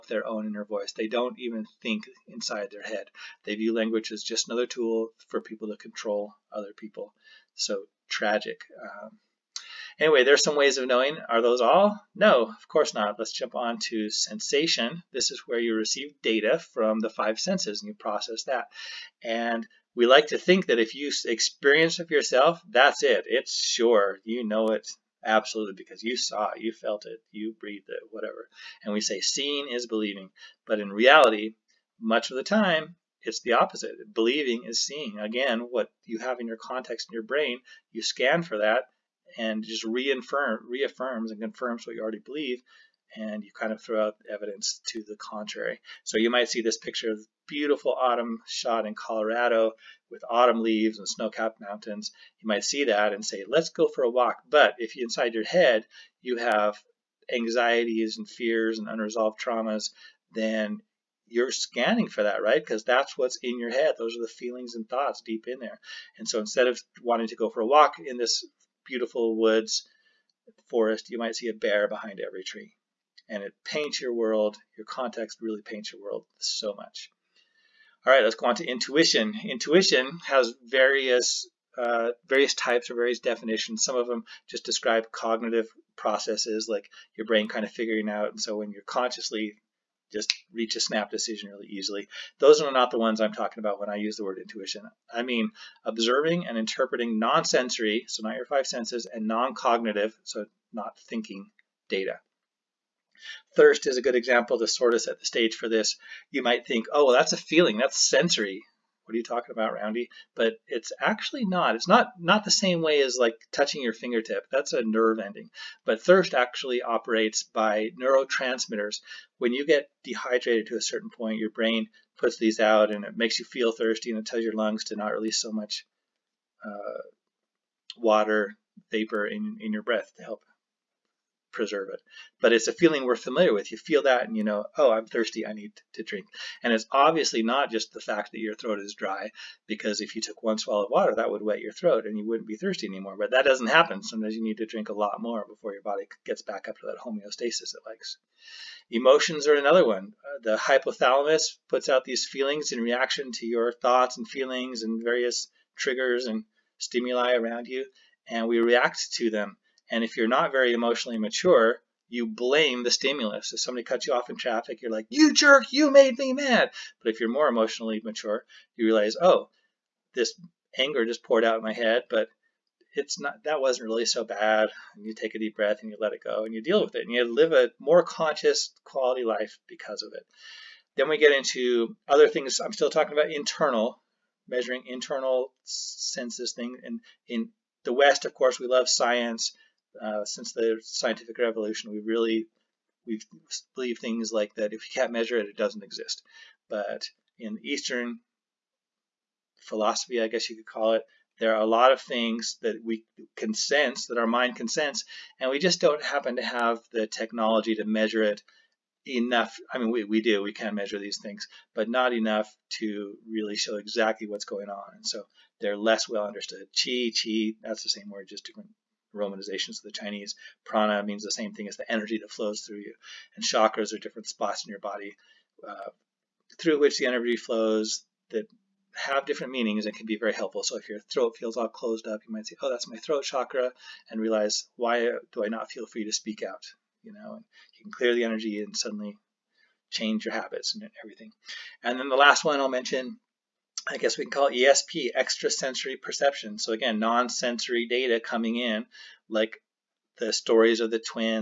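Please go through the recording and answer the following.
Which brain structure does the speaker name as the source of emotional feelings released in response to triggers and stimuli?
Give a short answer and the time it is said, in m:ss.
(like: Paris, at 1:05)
hypothalamus, at 2:30.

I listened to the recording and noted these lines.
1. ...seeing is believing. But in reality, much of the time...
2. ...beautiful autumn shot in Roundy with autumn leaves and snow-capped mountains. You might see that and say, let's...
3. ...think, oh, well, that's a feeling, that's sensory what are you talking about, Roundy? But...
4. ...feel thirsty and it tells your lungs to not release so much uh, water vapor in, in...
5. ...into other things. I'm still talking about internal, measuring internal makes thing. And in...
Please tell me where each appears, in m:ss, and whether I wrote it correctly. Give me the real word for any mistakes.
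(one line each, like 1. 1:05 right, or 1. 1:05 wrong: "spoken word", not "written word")
1. 0:29 right
2. 0:47 wrong: "Colorado", not "Roundy"
3. 1:46 right
4. 2:03 right
5. 3:01 wrong: "senses", not "makes".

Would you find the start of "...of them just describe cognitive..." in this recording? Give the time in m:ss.
1:23.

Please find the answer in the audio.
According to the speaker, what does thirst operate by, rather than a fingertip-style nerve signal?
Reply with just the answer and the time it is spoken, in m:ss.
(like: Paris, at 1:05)
neurotransmitters, at 1:57.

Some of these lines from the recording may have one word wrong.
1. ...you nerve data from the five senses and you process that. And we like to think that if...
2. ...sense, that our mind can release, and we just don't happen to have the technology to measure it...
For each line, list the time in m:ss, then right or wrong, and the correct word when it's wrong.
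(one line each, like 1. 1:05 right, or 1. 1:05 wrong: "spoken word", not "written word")
1. 0:15 wrong: "receive", not "nerve"
2. 3:23 wrong: "sense", not "release".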